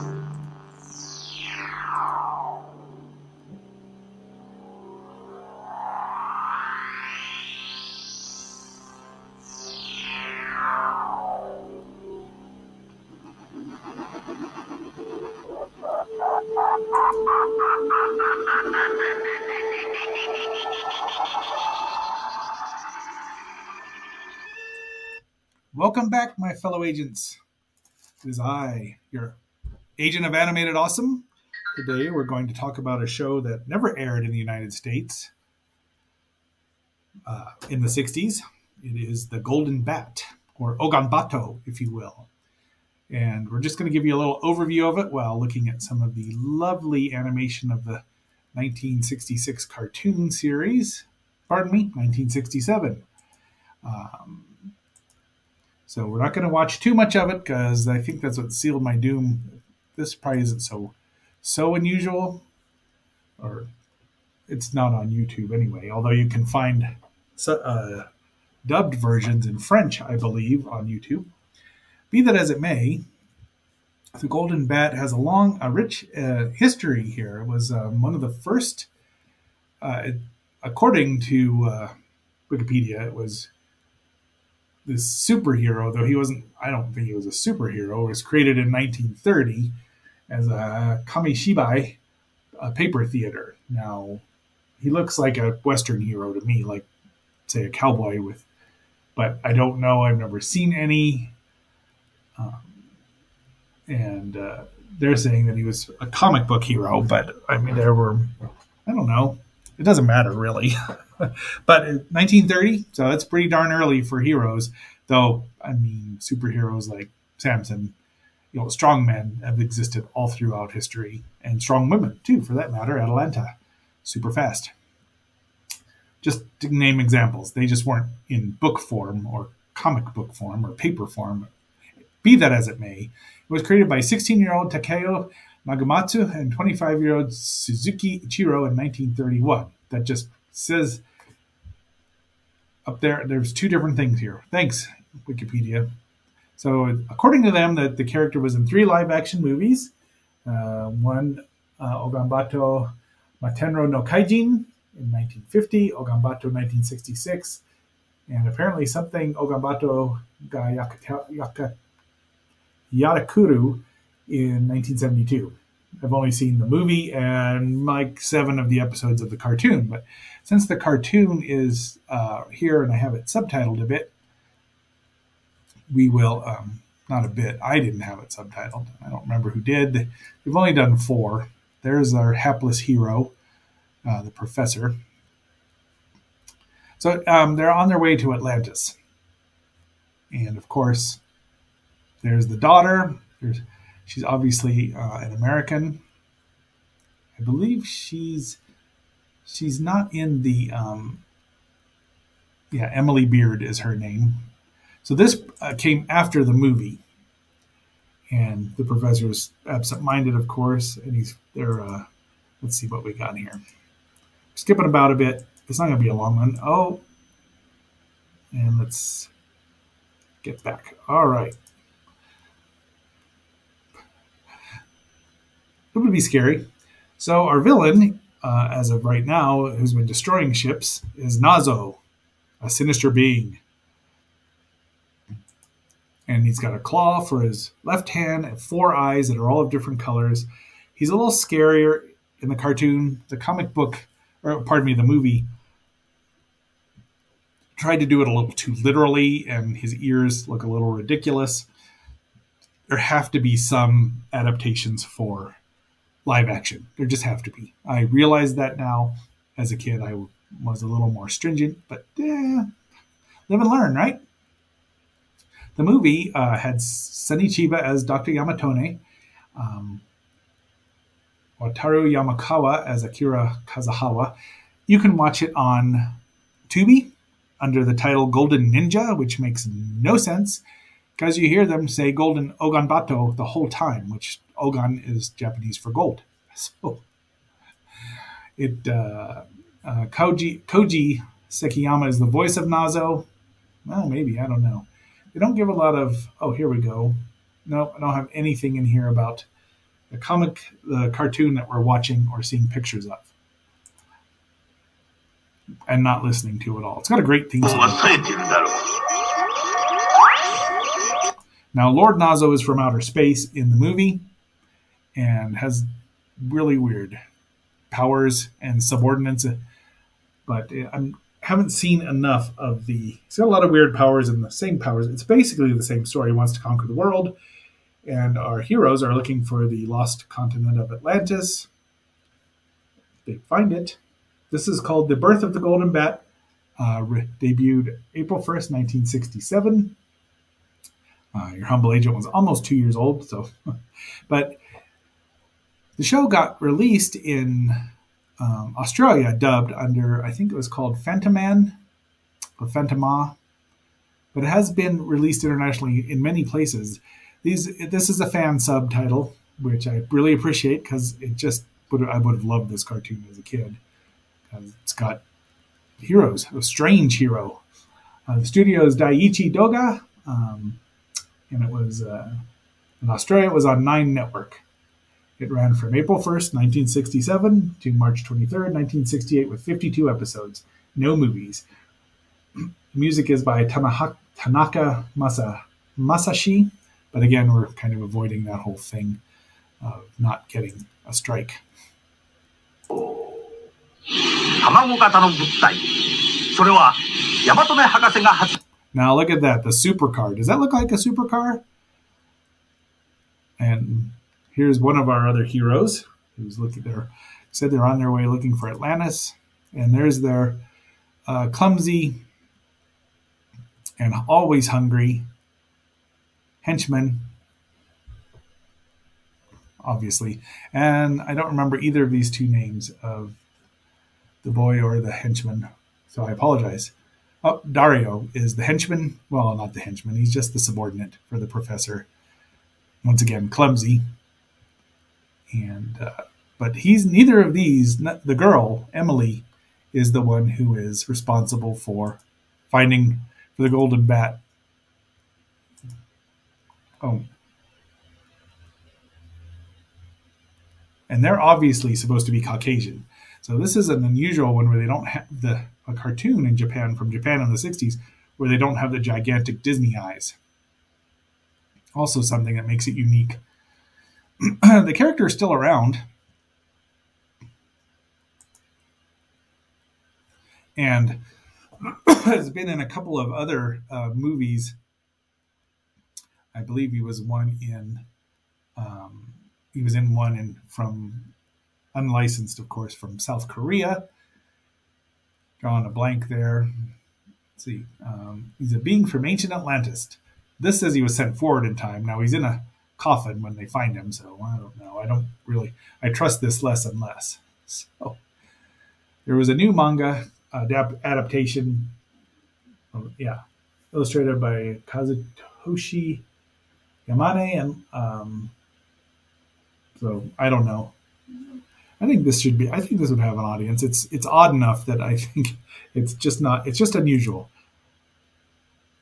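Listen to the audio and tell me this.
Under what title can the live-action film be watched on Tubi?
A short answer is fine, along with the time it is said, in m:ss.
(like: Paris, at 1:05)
Golden Ninja, at 4:38.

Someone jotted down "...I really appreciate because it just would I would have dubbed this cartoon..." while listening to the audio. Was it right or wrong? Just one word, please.
wrong.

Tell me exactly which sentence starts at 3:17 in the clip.
I believe she's she's not in the um, yeah Emily Beard is her name.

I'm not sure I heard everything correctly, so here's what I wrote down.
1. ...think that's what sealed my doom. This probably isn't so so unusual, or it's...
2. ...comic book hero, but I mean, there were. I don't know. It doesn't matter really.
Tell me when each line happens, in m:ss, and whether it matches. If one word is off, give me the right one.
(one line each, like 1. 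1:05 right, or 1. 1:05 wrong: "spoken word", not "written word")
1. 0:57 right
2. 1:46 right.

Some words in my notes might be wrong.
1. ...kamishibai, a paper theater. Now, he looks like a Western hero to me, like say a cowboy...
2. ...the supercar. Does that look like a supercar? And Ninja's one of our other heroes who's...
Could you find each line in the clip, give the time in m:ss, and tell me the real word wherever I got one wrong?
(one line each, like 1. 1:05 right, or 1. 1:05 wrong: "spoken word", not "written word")
1. 1:31 right
2. 6:39 wrong: "Here", not "Ninja".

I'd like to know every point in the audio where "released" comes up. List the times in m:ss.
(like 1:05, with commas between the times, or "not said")
5:46, 5:55.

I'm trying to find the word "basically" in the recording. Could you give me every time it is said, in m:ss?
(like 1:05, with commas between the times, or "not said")
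5:25.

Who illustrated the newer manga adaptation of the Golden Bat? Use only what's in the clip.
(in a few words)
Kazutoshi Yamane.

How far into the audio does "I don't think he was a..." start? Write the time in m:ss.
1:26.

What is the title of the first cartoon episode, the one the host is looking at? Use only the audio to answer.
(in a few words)
The Birth of the Golden Bat.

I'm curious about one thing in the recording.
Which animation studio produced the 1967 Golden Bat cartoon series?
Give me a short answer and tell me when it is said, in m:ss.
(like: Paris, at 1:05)
Daiichi Doga, at 6:08.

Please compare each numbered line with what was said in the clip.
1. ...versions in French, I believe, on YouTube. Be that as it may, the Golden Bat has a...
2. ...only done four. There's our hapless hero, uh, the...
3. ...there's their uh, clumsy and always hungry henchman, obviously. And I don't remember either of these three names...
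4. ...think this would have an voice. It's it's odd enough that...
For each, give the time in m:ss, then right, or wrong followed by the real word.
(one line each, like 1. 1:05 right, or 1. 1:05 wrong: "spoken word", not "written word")
1. 1:08 right
2. 3:00 right
3. 6:49 wrong: "two", not "three"
4. 8:32 wrong: "audience", not "voice".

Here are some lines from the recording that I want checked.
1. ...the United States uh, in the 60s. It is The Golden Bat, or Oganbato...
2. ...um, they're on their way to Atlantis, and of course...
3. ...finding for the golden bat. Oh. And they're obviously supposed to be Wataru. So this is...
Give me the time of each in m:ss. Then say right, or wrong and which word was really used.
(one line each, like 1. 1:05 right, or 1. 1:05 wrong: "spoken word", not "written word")
1. 0:34 right
2. 3:07 right
3. 7:22 wrong: "Caucasian", not "Wataru".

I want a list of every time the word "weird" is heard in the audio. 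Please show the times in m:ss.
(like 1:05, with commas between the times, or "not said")
5:16, 5:23.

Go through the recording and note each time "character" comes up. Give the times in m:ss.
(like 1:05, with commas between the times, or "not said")
2:28, 7:44.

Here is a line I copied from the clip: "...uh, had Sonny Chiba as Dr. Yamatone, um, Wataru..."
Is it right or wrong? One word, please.
right.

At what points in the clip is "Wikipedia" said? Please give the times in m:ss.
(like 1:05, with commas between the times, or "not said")
1:22, 2:25.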